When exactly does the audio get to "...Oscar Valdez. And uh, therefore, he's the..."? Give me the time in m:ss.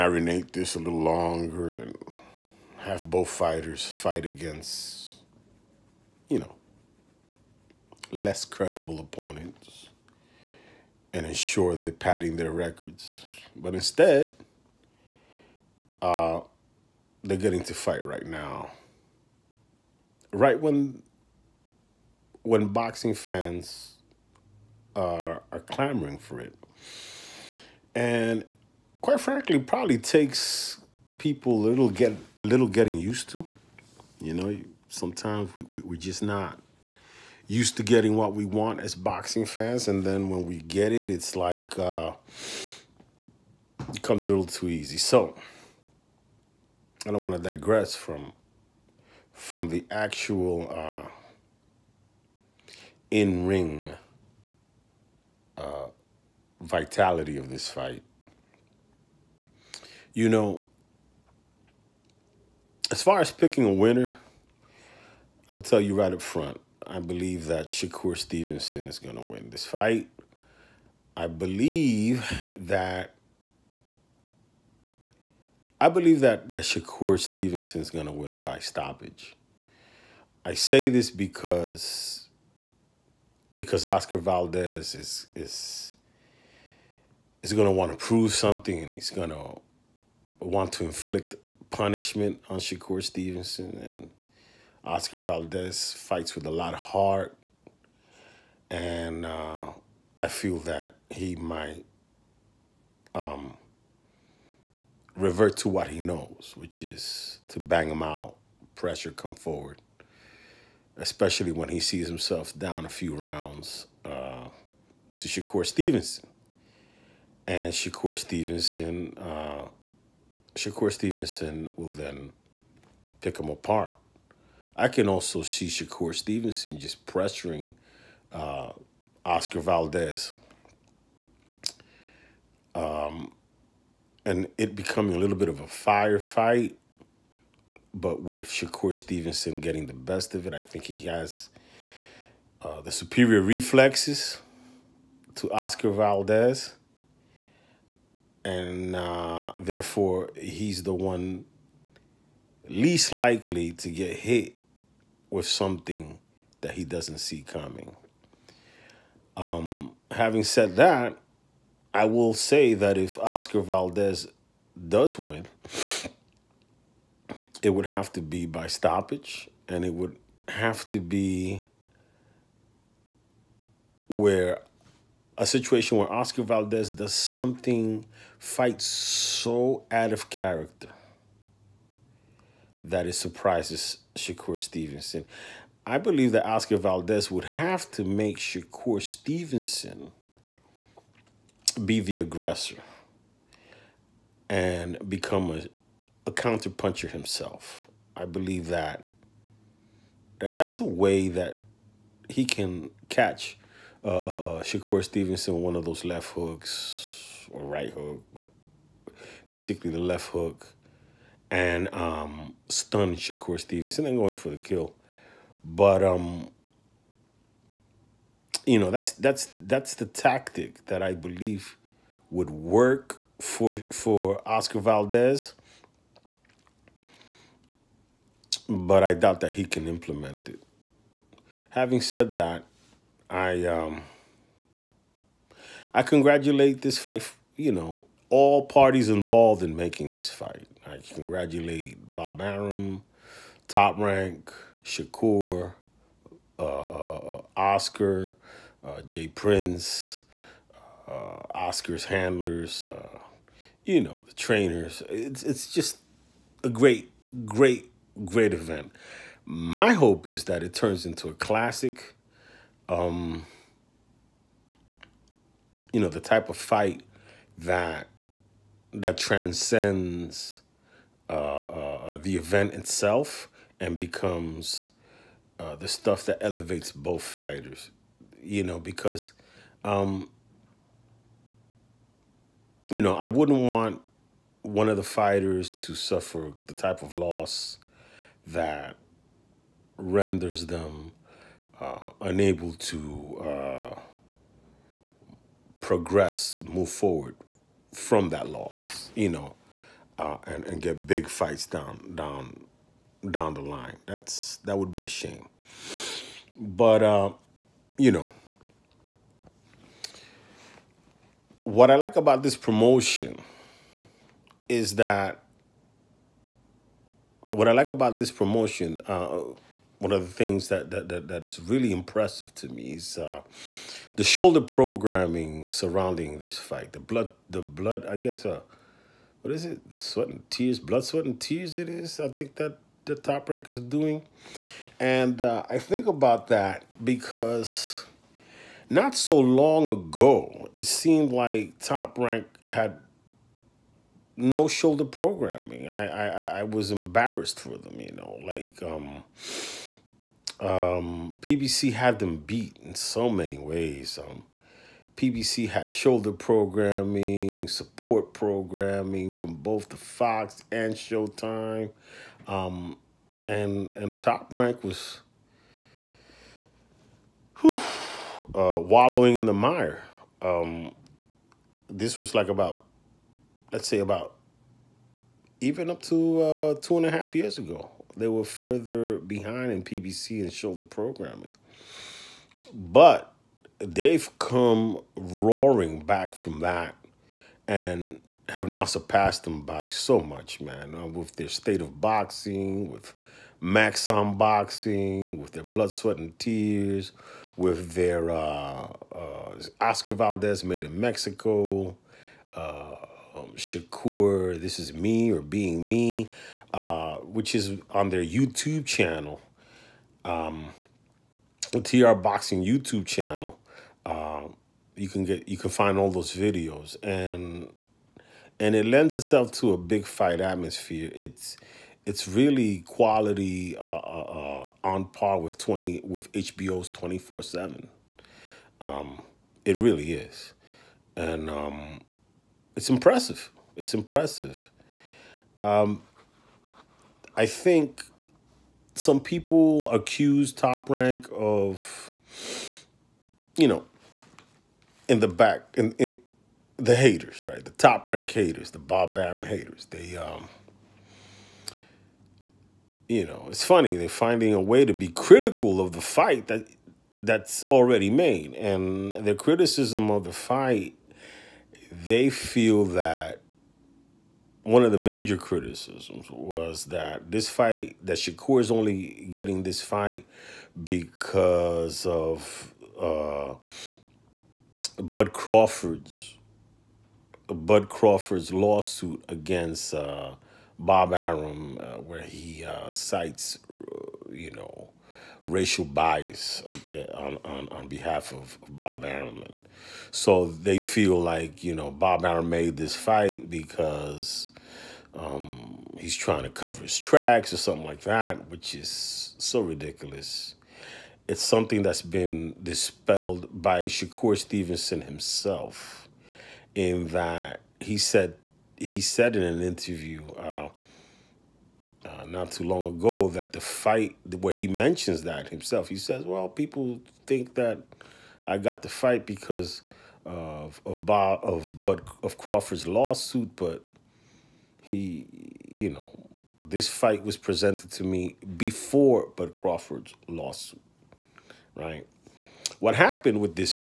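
2:25.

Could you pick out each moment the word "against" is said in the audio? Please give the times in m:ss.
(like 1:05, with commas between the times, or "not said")
0:04, 7:59.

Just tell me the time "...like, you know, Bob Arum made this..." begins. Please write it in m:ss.
8:11.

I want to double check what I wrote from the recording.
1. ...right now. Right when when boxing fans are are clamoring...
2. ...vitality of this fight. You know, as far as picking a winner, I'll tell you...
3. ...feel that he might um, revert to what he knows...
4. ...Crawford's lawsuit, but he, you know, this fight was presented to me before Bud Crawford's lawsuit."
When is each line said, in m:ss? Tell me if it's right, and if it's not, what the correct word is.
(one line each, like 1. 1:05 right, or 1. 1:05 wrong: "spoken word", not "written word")
1. 0:18 right
2. 0:56 right
3. 1:40 right
4. 8:42 right.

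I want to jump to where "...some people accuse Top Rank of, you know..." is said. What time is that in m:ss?
7:18.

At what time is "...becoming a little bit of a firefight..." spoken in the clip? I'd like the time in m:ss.
2:14.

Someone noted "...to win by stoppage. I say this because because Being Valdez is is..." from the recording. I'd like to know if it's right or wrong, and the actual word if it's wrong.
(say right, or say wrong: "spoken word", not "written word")
wrong: "Oscar", not "Being".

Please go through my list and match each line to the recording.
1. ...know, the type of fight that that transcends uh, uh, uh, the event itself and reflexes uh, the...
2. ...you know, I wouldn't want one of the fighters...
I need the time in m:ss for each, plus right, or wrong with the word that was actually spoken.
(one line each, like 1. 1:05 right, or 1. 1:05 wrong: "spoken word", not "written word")
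1. 4:25 wrong: "becomes", not "reflexes"
2. 4:42 right.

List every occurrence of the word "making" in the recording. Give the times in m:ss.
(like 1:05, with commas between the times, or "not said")
3:59.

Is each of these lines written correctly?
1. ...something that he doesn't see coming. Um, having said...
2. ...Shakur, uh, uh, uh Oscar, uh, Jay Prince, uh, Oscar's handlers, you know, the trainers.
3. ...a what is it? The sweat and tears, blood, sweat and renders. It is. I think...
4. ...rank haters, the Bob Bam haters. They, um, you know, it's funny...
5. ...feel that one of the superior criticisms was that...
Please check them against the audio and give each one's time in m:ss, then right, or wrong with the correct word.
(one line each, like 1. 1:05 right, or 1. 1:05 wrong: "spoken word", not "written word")
1. 2:35 right
2. 4:04 right
3. 5:28 wrong: "tears", not "renders"
4. 7:28 right
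5. 7:42 wrong: "major", not "superior".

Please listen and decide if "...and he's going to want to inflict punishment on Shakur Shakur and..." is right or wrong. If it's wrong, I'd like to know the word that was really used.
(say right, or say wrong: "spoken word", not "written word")
wrong: "Stevenson", not "Shakur".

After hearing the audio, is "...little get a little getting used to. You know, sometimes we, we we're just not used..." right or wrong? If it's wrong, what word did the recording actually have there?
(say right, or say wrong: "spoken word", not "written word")
right.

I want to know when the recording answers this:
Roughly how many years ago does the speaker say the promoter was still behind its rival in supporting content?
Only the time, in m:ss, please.
6:16.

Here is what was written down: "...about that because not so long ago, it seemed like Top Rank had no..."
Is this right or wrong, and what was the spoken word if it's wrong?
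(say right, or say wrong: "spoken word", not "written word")
right.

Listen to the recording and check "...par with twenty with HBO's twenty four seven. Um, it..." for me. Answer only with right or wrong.
right.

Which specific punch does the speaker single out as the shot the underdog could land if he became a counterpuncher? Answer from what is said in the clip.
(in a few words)
Left hook.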